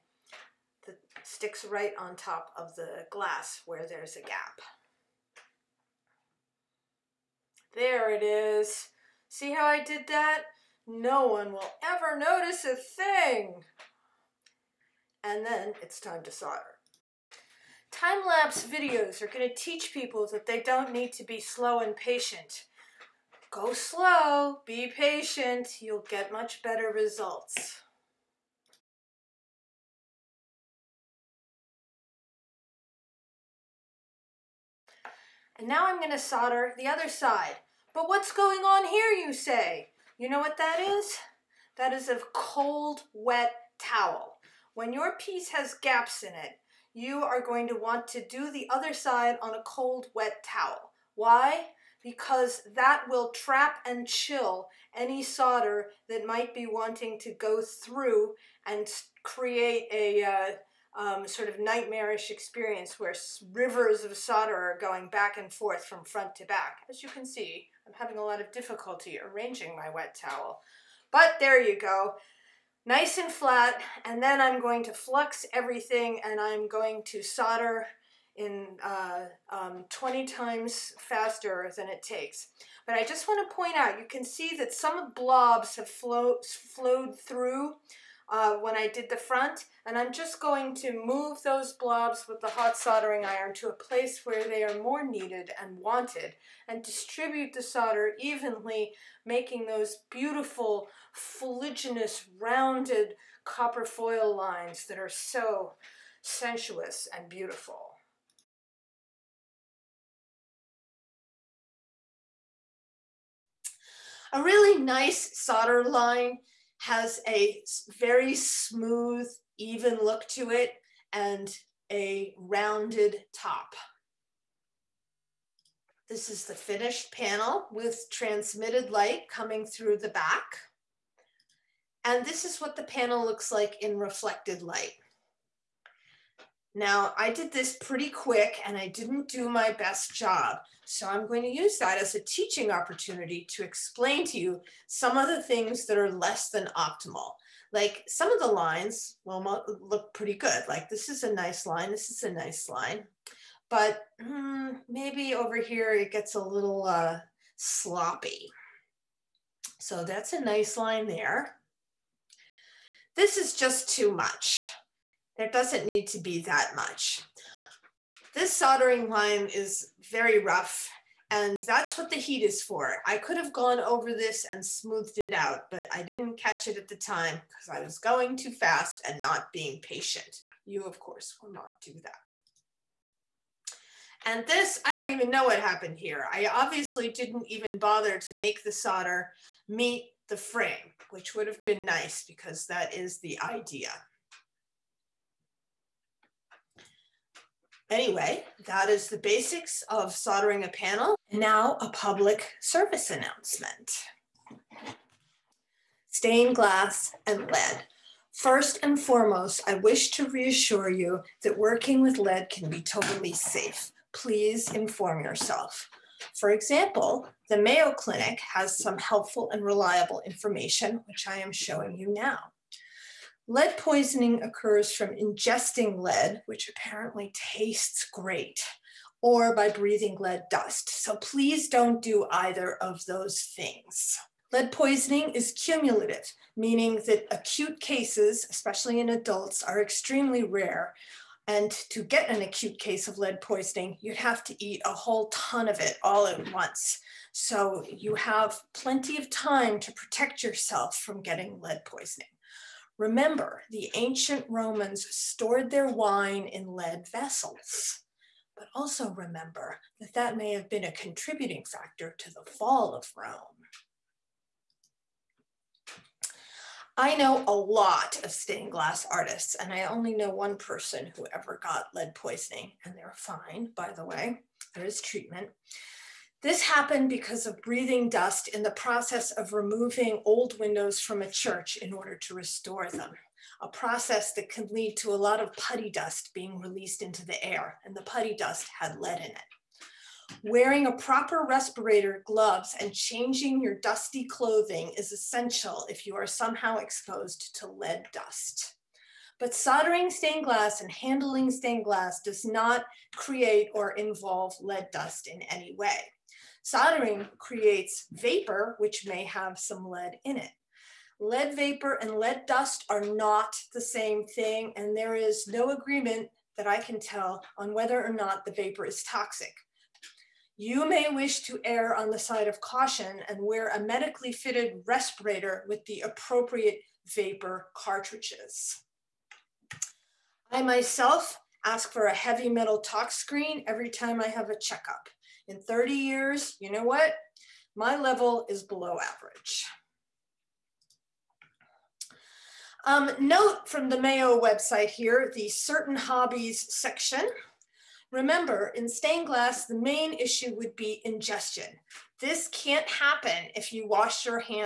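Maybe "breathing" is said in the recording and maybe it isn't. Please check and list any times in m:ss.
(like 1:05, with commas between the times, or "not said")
3:49, 4:37.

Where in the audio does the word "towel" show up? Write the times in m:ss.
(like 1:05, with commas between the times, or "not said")
0:43, 0:50, 1:10.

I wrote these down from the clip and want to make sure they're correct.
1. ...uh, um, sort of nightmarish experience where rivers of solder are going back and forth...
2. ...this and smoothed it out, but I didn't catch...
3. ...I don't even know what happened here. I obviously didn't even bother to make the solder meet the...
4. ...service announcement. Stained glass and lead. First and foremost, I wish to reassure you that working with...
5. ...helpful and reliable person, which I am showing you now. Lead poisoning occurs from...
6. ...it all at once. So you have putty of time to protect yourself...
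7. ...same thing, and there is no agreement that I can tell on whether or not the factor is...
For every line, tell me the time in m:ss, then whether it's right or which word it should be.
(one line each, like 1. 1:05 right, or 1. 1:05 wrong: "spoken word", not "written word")
1. 1:00 right
2. 2:54 right
3. 3:04 right
4. 3:22 right
5. 3:38 wrong: "information", not "person"
6. 4:05 wrong: "plenty", not "putty"
7. 5:13 wrong: "vapor", not "factor".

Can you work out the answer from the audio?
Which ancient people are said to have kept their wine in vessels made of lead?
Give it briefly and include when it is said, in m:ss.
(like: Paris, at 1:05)
ancient Romans, at 4:13.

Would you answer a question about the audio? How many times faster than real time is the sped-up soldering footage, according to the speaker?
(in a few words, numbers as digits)
20 times.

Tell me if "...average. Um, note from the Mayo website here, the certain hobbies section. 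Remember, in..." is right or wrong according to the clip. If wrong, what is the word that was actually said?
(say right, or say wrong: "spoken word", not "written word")
right.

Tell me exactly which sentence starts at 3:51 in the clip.
So please don't do either of those things.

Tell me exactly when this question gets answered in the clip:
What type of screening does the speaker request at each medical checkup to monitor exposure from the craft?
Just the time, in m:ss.
5:32.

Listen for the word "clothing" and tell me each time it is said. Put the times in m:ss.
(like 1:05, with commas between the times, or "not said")
4:54.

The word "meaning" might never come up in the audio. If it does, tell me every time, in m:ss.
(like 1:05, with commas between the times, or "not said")
3:56.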